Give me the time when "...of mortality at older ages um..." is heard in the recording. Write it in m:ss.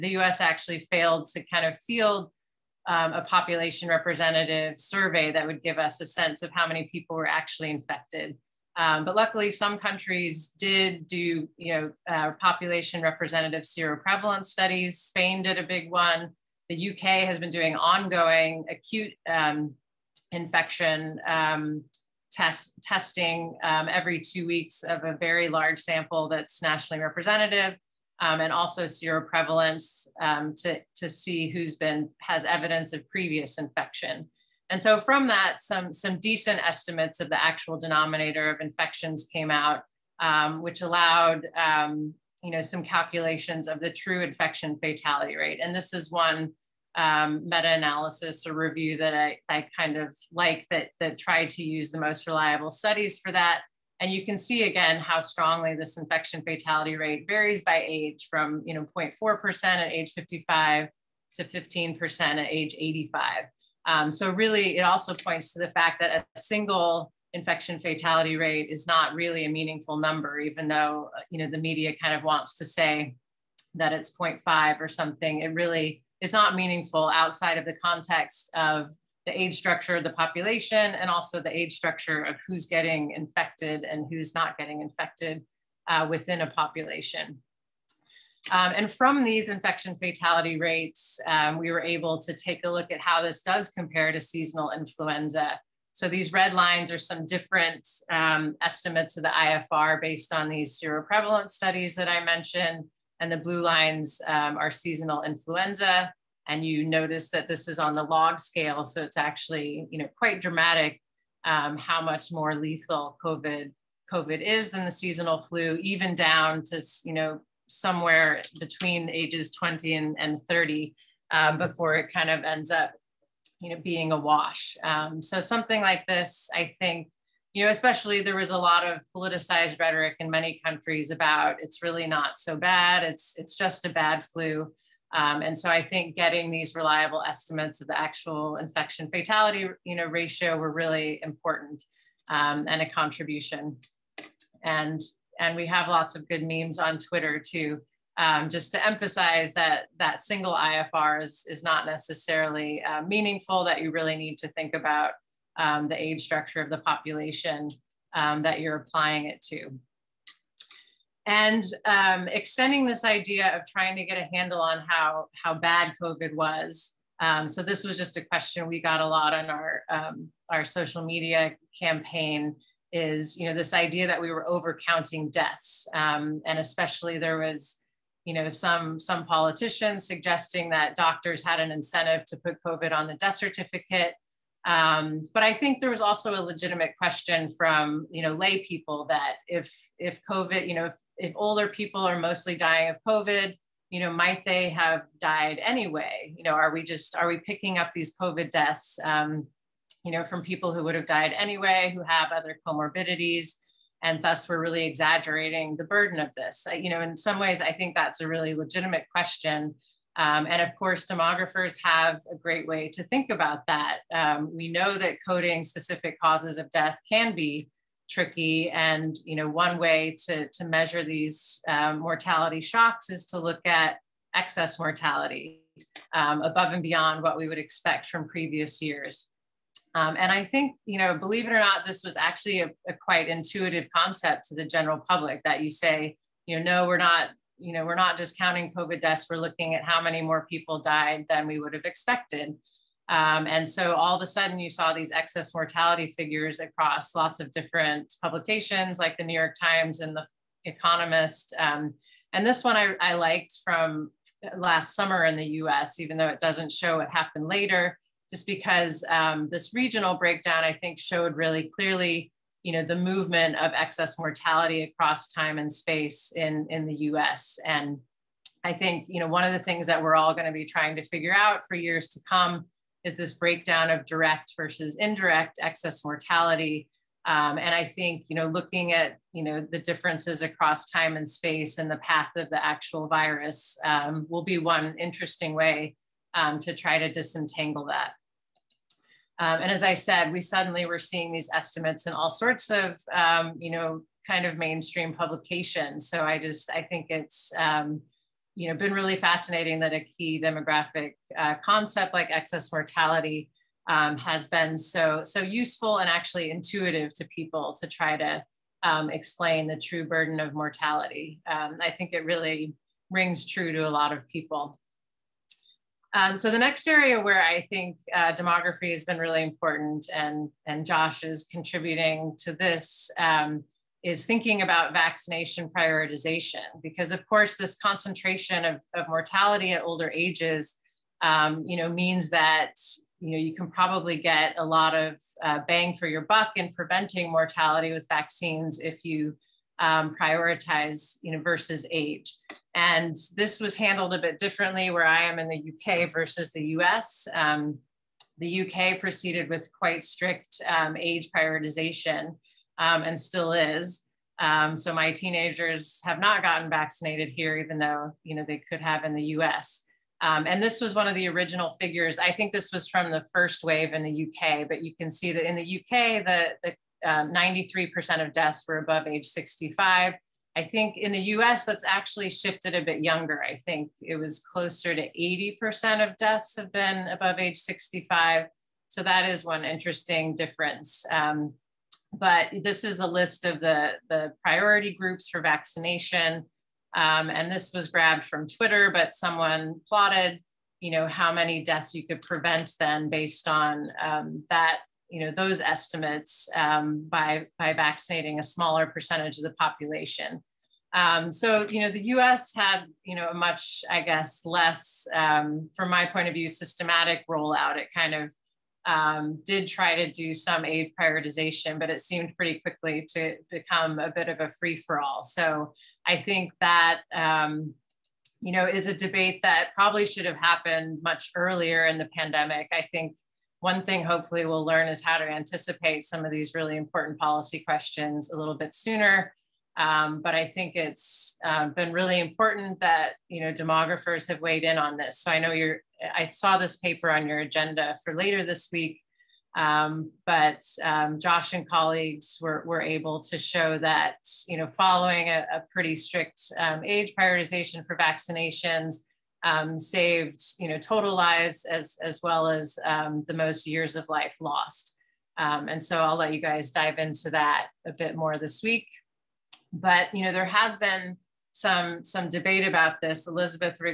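5:28.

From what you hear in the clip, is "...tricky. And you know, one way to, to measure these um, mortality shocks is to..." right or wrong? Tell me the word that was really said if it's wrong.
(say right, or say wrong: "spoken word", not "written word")
right.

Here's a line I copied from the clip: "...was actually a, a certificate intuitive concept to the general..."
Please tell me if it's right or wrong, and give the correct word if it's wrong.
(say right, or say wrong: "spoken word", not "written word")
wrong: "quite", not "certificate".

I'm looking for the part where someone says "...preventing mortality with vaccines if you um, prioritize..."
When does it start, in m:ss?
5:36.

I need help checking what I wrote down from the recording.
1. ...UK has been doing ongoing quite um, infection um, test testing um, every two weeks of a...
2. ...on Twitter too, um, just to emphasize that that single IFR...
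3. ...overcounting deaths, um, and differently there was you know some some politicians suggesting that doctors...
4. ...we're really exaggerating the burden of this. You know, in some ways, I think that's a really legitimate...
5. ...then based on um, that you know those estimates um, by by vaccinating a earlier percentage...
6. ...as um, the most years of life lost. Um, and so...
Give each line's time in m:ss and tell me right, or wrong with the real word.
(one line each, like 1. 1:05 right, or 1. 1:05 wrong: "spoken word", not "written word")
1. 0:16 wrong: "acute", not "quite"
2. 2:26 right
3. 2:54 wrong: "especially", not "differently"
4. 3:24 right
5. 6:32 wrong: "smaller", not "earlier"
6. 7:32 right.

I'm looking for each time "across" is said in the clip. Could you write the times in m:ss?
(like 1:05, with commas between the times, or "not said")
4:06, 4:24, 4:40.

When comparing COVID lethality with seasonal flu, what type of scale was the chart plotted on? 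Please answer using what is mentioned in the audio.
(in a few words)
log scale.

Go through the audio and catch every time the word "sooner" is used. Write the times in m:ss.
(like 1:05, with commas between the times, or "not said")
7:08.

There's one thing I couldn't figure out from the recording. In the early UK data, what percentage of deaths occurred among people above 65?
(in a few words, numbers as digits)
93%.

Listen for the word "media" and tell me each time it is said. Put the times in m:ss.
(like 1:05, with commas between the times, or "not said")
1:11, 2:51.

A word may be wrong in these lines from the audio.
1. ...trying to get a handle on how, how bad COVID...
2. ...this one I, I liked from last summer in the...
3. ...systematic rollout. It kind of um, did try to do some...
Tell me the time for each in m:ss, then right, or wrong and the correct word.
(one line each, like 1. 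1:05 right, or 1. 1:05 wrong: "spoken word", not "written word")
1. 2:43 right
2. 4:12 right
3. 6:46 right.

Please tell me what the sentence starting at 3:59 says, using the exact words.
We're looking at how many more people died than we would have expected.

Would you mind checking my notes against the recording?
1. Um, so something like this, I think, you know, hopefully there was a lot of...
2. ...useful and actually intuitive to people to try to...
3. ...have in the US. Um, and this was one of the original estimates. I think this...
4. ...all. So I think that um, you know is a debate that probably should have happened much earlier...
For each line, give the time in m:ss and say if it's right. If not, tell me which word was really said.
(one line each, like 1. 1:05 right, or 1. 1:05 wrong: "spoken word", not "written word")
1. 2:04 wrong: "especially", not "hopefully"
2. 5:05 right
3. 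5:58 wrong: "figures", not "estimates"
4. 6:55 right.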